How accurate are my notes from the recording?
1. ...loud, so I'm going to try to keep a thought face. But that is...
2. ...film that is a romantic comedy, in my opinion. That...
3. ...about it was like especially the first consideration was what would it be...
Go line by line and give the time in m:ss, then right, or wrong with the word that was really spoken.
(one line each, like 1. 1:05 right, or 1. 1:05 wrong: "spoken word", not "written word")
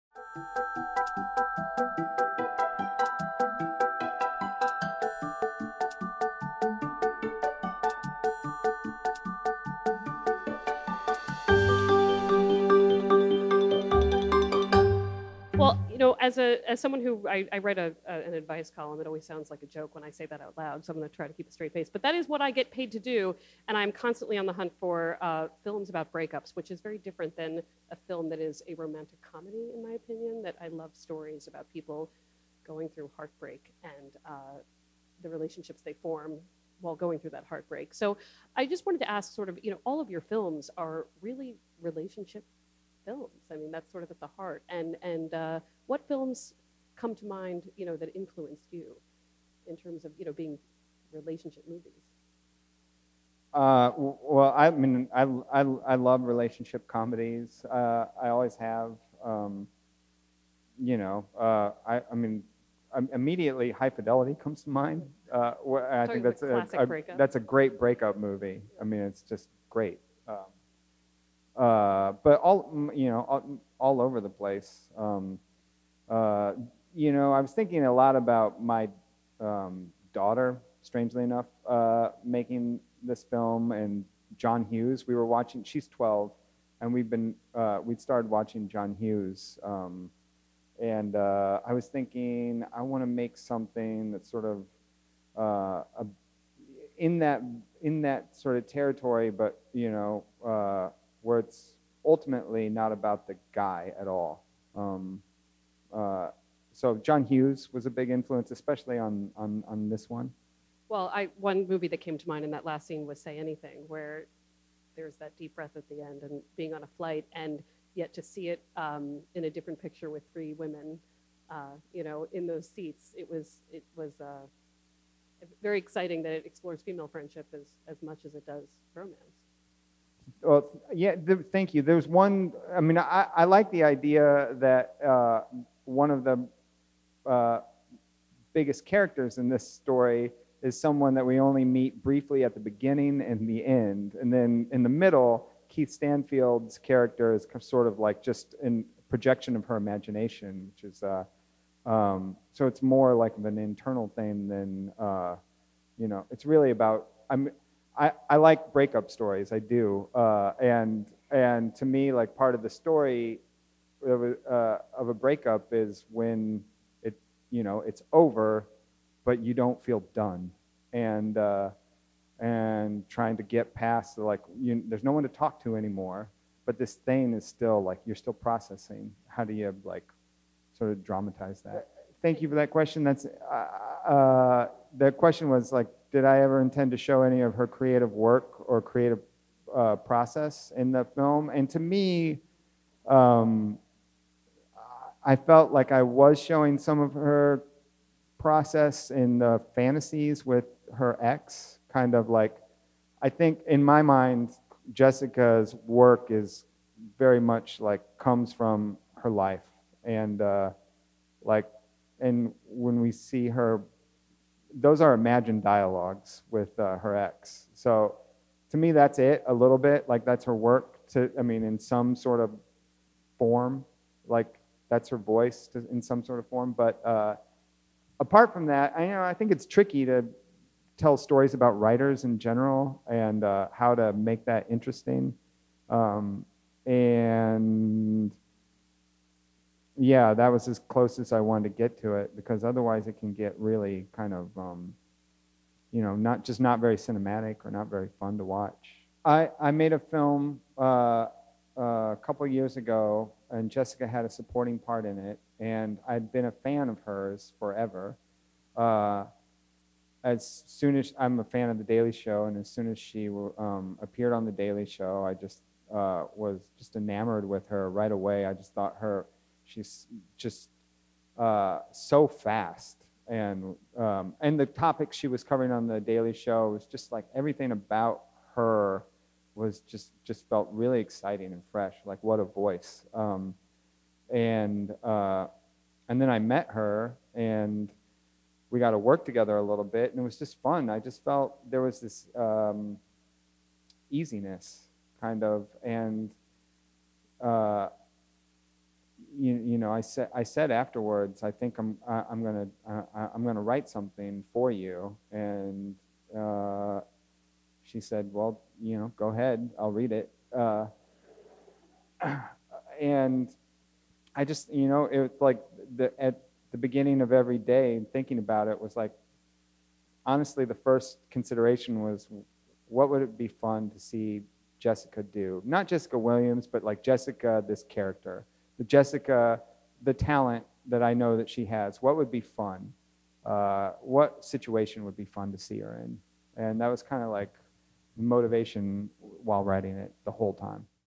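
1. 0:20 wrong: "straight", not "thought"
2. 0:28 right
3. 5:18 wrong: "honestly", not "especially".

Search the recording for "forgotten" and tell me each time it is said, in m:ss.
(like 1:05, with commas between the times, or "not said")
not said.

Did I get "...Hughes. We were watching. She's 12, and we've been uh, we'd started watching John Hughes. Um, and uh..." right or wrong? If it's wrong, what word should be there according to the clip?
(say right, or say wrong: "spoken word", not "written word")
right.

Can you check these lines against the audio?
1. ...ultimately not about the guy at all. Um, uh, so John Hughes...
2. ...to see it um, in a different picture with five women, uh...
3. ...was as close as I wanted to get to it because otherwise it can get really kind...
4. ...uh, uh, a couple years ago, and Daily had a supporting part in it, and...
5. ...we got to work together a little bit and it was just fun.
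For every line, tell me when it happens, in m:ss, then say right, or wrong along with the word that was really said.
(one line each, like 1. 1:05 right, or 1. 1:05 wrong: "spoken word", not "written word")
1. 1:42 right
2. 1:58 wrong: "three", not "five"
3. 4:00 right
4. 4:10 wrong: "Jessica", not "Daily"
5. 4:48 right.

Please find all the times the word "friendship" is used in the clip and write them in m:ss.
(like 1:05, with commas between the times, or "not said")
2:07.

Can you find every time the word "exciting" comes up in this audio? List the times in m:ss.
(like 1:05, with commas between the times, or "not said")
2:05, 4:40.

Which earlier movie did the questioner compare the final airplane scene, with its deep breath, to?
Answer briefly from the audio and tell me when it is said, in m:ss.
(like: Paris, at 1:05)
Say Anything, at 1:53.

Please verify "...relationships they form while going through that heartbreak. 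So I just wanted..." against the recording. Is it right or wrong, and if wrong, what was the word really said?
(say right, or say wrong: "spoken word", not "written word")
right.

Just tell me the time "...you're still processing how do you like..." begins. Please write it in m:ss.
2:58.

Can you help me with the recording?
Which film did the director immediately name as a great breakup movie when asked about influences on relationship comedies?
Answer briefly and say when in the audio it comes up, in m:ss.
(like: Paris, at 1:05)
High Fidelity, at 1:03.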